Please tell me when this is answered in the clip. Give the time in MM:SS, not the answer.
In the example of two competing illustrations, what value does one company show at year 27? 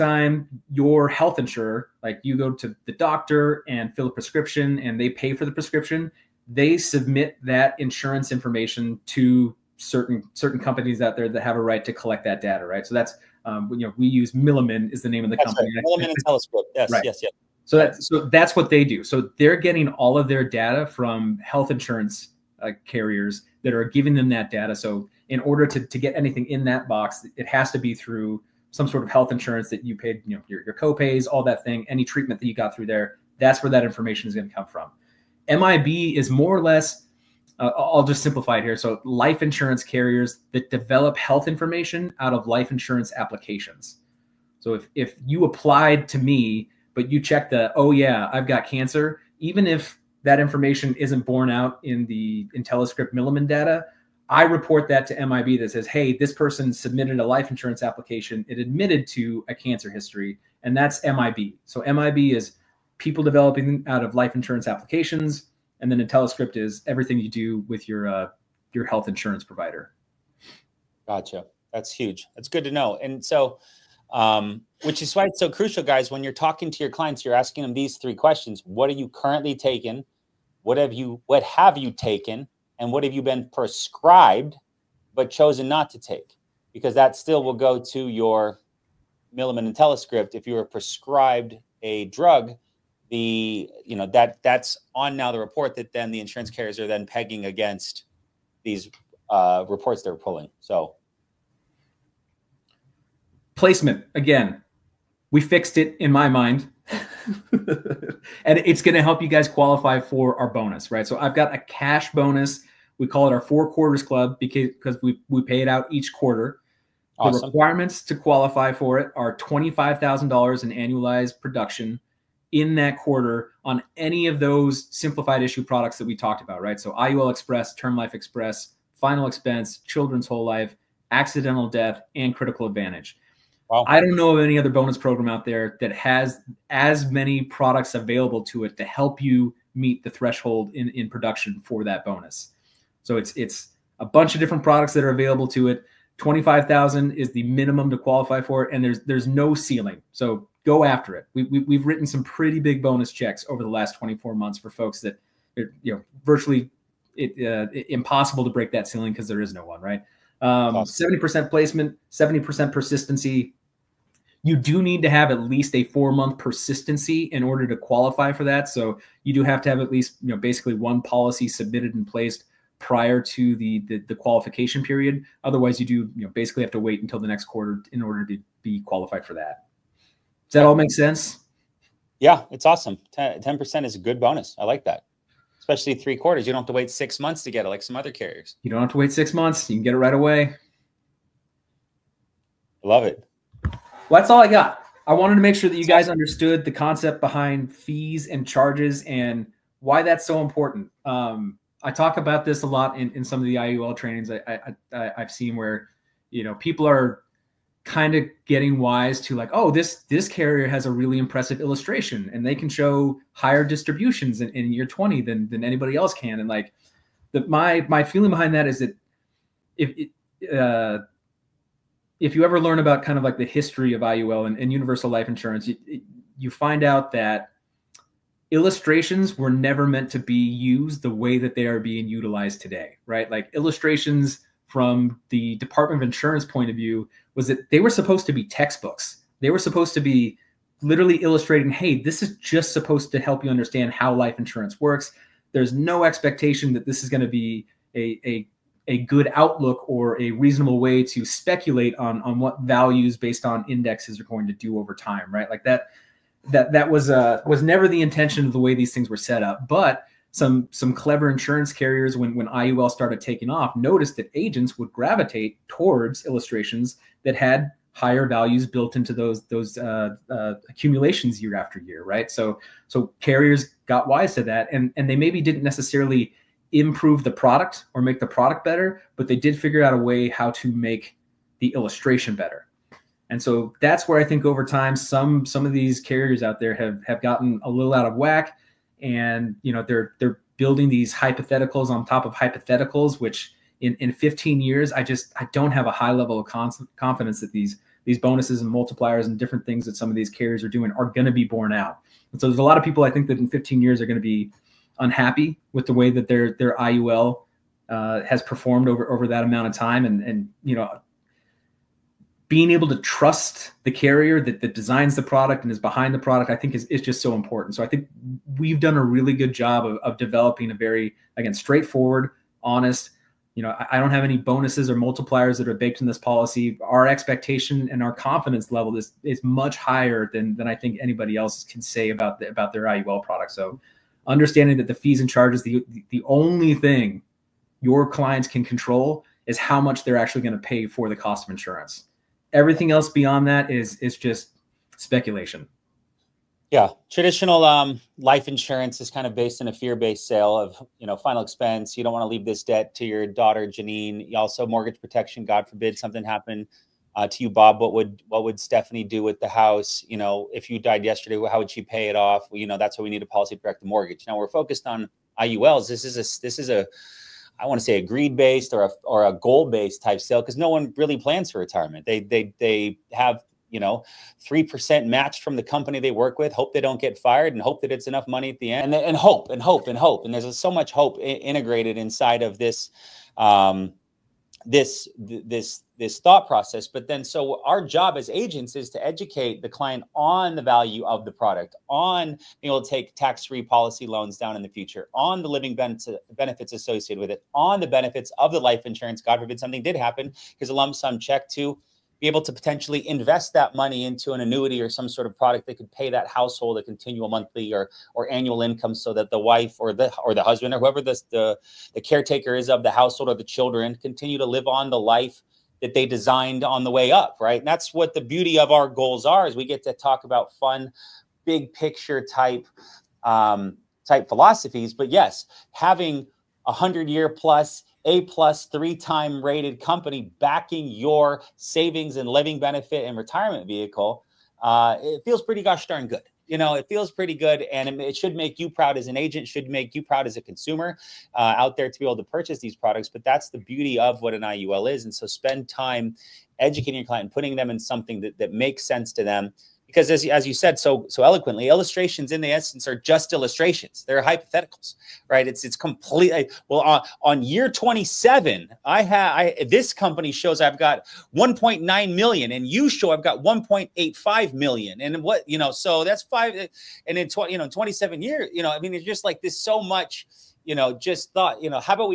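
07:41.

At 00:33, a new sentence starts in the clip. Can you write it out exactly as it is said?
That's where that information is going to come from.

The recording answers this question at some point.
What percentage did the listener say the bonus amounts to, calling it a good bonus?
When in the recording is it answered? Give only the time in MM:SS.
03:03.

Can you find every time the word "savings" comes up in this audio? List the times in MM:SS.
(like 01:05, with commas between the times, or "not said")
07:11.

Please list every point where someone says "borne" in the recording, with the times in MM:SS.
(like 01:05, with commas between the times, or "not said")
00:51, 05:01.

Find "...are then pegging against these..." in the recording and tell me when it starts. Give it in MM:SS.
01:36.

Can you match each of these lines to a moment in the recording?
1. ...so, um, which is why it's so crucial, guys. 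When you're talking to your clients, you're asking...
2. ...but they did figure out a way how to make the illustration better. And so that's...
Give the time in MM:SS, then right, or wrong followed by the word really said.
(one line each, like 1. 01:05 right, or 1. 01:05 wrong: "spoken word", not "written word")
1. 01:13 right
2. 04:39 right.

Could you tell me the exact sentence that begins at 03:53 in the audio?
Like illustrations from the Department of Insurance point of view was that they were supposed to be textbooks.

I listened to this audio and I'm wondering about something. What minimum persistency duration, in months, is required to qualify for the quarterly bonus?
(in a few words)
4 months.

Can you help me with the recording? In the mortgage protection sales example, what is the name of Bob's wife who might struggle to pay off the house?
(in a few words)
Stephanie.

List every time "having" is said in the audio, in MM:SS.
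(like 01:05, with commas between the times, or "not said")
07:05.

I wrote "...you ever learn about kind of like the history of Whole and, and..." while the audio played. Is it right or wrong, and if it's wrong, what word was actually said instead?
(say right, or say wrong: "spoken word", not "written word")
wrong: "IUL", not "Whole".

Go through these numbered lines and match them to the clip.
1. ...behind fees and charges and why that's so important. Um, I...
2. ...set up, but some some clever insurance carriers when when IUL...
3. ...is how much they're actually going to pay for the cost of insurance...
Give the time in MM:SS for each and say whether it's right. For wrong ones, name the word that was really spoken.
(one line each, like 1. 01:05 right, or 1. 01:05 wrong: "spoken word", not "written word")
1. 03:17 right
2. 04:19 right
3. 05:39 right.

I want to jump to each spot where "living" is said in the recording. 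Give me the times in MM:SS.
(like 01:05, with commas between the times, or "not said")
06:35, 07:12.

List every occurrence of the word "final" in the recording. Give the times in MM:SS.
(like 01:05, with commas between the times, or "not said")
02:08, 05:51.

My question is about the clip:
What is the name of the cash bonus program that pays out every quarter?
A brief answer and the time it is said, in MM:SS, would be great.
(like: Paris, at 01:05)
Four Quarters Club, at 01:53.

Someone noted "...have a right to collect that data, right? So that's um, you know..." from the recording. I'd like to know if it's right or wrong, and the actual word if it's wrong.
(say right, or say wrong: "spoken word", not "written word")
right.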